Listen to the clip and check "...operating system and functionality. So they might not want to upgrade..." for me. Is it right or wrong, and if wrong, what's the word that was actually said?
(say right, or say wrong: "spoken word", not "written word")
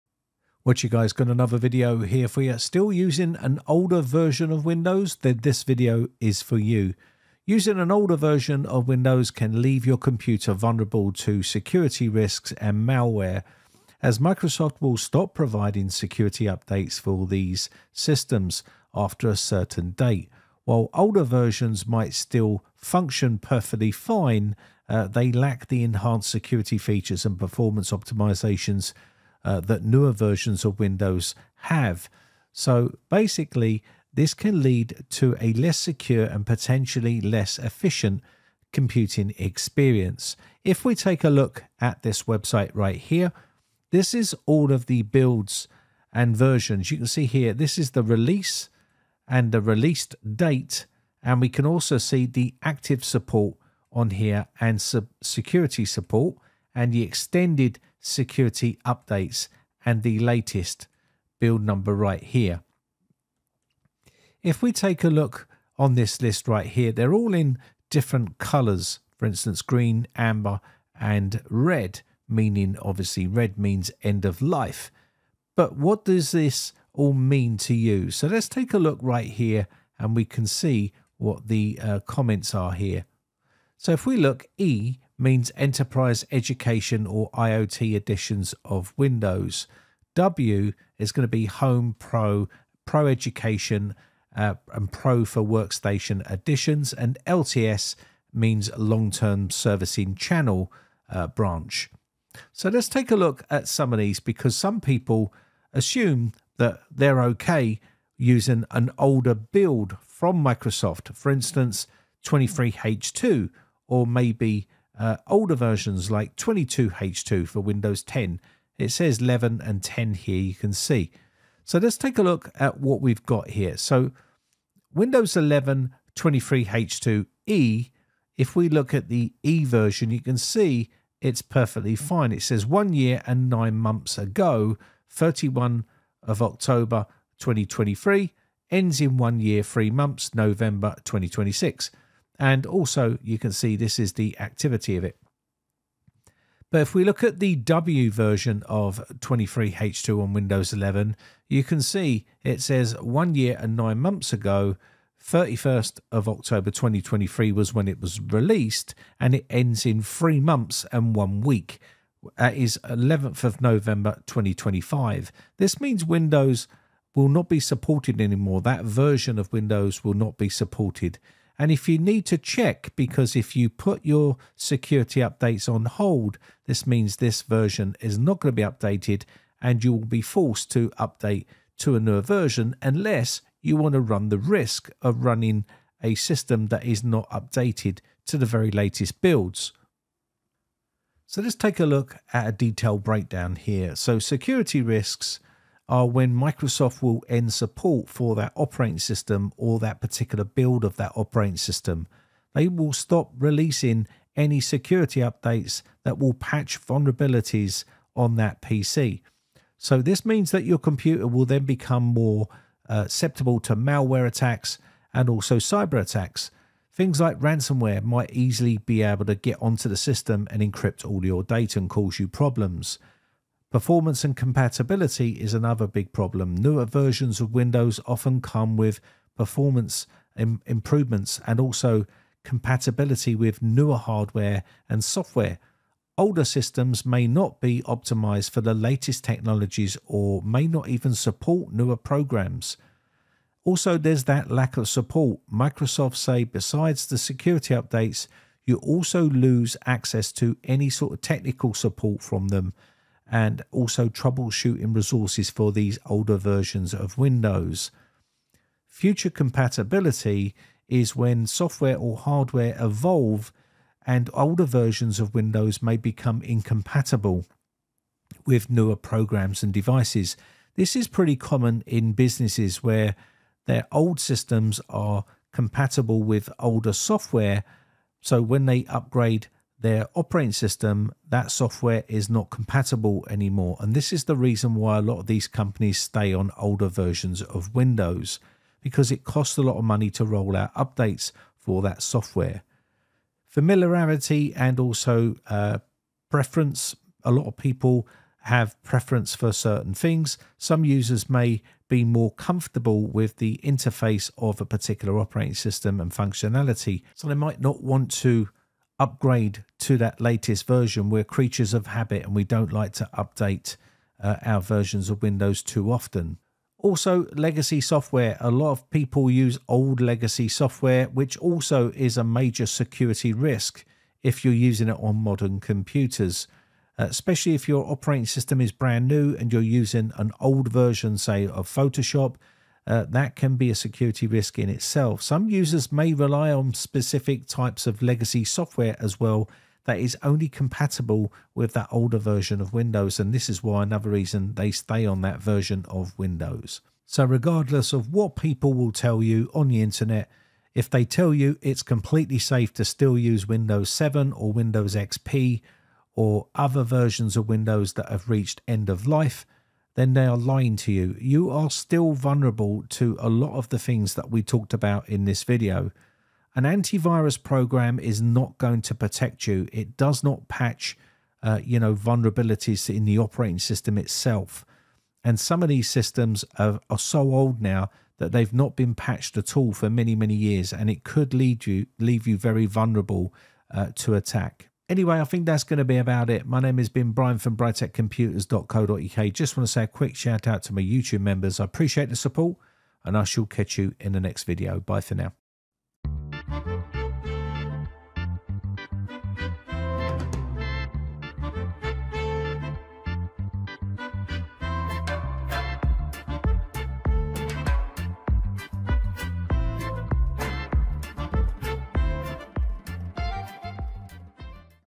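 right.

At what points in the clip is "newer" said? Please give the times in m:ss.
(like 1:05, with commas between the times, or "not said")
0:29, 3:01, 3:46, 3:53, 4:01, 4:28.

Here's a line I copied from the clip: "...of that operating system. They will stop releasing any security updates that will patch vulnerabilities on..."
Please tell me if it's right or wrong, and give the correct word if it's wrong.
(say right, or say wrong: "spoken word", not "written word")
right.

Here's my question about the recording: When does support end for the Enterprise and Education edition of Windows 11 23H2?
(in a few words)
November 2026.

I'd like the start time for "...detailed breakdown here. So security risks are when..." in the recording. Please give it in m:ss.
3:12.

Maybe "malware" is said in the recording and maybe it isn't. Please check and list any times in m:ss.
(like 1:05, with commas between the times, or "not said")
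0:12, 3:33.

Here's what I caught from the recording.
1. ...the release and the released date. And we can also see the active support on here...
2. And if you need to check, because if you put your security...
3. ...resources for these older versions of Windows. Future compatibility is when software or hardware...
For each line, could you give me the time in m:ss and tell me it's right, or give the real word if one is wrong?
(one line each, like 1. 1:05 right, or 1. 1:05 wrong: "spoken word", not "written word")
1. 0:47 right
2. 2:51 right
3. 4:14 right.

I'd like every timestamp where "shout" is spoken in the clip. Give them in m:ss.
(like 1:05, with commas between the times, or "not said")
6:30.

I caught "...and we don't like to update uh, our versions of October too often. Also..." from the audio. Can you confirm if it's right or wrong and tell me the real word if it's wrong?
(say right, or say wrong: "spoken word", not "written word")
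wrong: "Windows", not "October".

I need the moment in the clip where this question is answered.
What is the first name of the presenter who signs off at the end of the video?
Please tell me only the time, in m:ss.
6:27.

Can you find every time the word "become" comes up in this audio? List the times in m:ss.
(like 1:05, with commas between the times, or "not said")
3:31, 4:25.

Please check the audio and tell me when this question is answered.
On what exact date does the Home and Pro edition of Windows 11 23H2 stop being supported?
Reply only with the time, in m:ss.
2:42.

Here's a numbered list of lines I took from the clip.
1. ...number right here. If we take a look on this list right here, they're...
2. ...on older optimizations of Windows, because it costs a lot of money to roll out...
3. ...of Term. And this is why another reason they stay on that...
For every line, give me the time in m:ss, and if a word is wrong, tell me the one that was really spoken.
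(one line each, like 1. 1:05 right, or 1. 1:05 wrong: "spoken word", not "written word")
1. 1:01 right
2. 4:46 wrong: "versions", not "optimizations"
3. 5:42 wrong: "Windows", not "Term".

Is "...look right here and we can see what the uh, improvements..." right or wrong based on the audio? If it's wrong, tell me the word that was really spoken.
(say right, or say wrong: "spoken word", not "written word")
wrong: "comments", not "improvements".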